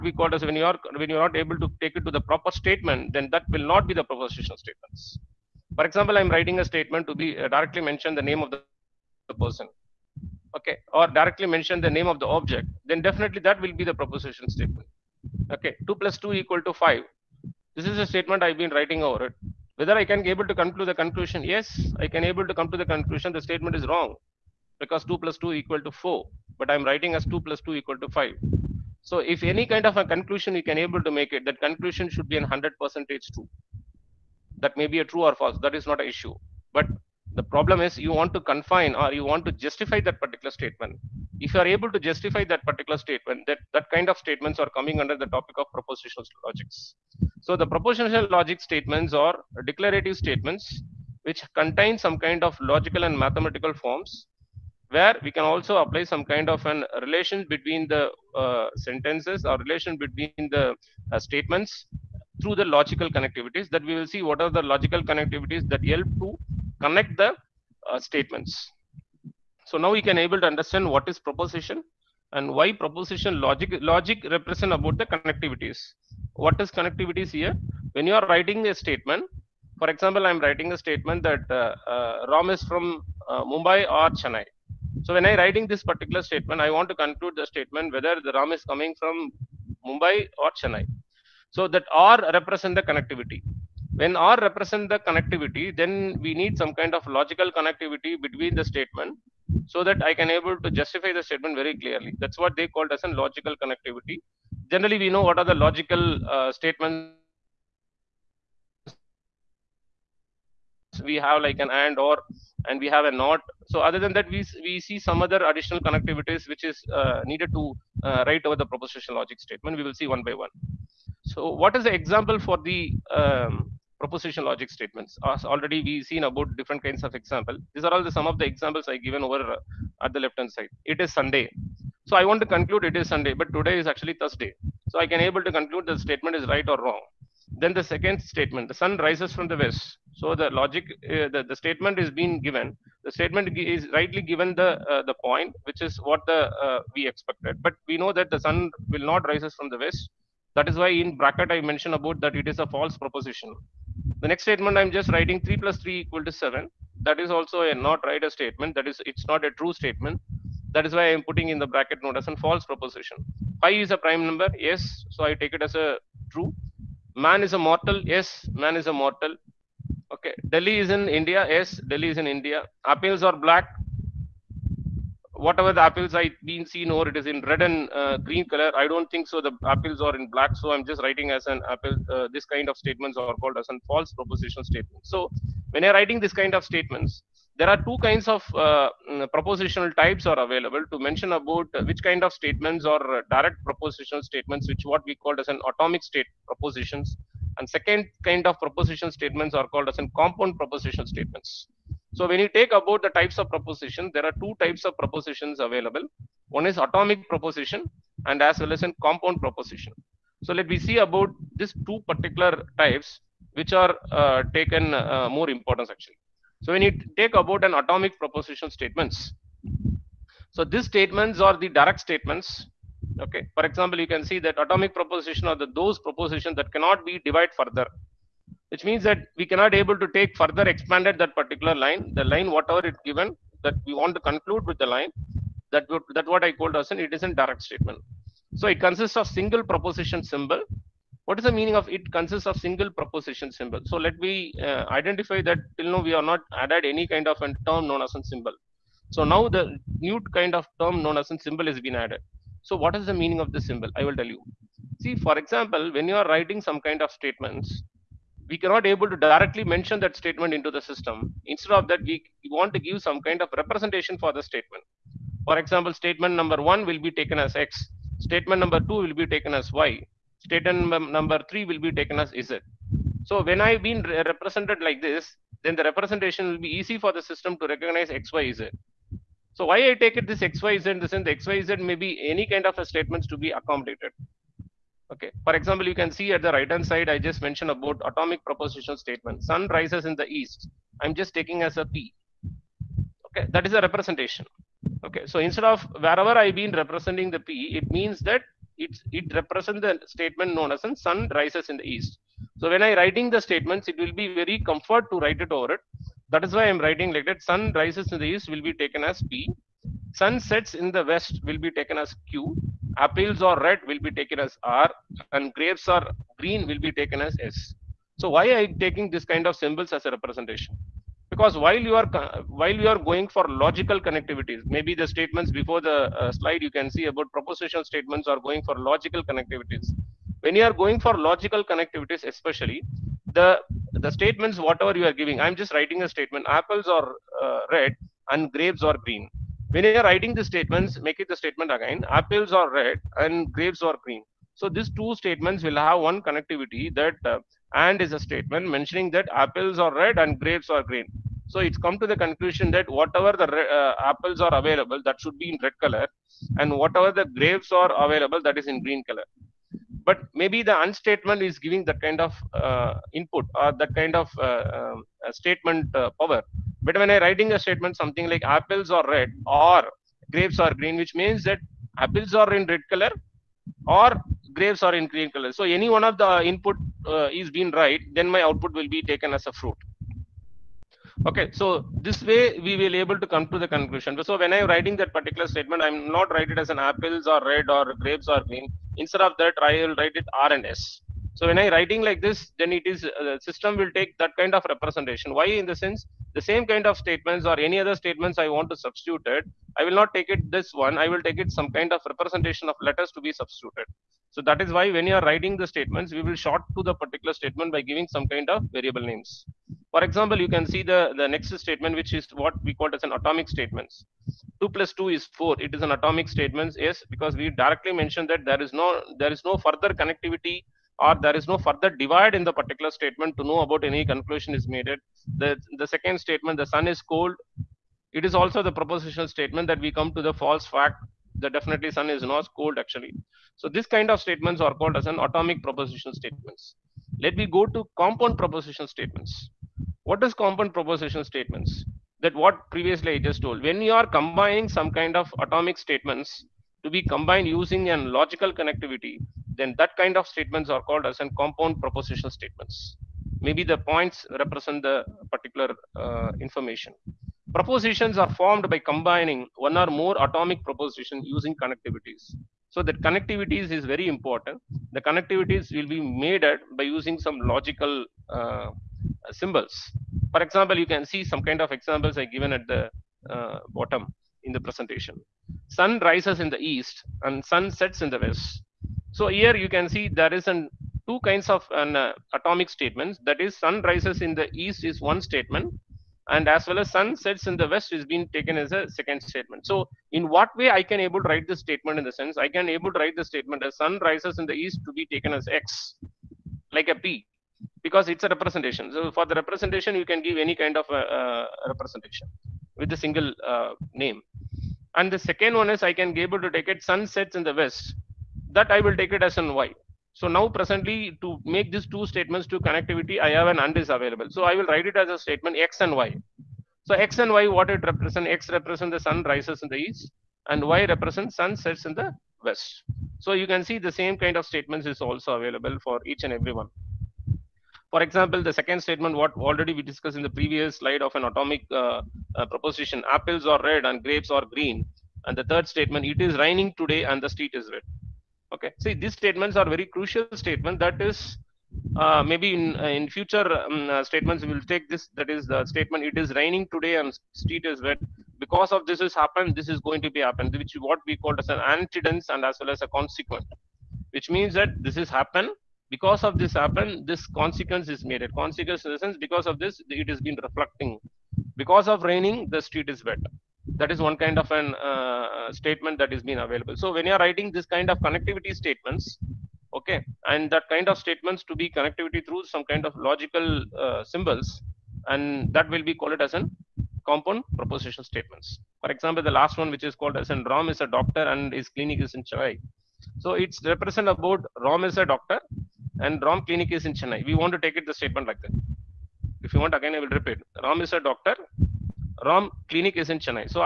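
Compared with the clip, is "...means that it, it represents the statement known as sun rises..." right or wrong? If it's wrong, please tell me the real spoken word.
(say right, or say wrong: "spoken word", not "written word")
right.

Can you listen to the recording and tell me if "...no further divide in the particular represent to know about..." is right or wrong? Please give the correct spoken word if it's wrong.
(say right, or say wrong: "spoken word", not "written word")
wrong: "statement", not "represent".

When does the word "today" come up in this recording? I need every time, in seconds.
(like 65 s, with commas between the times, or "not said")
133 s, 536 s, 546 s.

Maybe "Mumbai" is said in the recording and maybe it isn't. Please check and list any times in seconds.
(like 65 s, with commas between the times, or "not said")
83 s, 89 s.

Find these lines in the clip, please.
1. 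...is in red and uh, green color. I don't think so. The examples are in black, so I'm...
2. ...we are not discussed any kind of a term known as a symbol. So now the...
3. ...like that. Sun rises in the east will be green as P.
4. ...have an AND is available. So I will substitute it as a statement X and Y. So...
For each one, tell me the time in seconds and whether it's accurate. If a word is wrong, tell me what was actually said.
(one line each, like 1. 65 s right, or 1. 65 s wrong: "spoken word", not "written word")
1. 177 s wrong: "apples", not "examples"
2. 246 s wrong: "added", not "discussed"
3. 307 s wrong: "taken", not "green"
4. 513 s wrong: "write", not "substitute".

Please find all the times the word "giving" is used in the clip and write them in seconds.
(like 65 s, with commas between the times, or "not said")
335 s, 361 s, 407 s.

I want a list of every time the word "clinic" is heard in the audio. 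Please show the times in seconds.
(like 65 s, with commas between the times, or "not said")
581 s, 586 s, 592 s.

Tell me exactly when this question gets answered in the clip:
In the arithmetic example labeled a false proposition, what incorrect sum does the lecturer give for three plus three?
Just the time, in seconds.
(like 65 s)
155 s.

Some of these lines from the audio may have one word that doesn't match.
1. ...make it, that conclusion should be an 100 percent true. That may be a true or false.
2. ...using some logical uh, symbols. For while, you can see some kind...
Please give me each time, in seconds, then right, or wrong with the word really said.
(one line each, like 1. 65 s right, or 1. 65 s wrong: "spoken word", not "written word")
1. 31 s right
2. 466 s wrong: "example", not "while".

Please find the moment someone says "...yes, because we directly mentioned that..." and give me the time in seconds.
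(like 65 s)
416 s.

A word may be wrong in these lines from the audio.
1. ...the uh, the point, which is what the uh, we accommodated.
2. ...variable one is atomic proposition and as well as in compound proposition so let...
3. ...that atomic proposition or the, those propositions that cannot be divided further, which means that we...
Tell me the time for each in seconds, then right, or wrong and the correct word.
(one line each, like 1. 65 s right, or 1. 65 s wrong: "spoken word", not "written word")
1. 144 s wrong: "expected", not "accommodated"
2. 205 s wrong: "available", not "variable"
3. 224 s right.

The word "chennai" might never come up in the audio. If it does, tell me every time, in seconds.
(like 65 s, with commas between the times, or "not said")
84 s, 90 s, 582 s, 587 s.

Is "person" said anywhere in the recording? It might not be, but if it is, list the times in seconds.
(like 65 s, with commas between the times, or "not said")
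9 s.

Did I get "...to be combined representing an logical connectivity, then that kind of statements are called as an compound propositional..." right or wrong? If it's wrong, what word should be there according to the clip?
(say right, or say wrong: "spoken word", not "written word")
wrong: "using", not "representing".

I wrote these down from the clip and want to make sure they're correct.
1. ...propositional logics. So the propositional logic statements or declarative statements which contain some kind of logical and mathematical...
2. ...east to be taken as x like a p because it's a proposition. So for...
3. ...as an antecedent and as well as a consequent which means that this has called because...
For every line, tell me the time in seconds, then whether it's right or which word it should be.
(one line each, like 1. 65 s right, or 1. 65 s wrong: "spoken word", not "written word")
1. 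45 s right
2. 494 s wrong: "representation", not "proposition"
3. 551 s wrong: "happened", not "called".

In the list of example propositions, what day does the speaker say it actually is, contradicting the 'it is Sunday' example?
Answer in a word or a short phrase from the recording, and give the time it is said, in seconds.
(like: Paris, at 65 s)
Thursday, at 134 s.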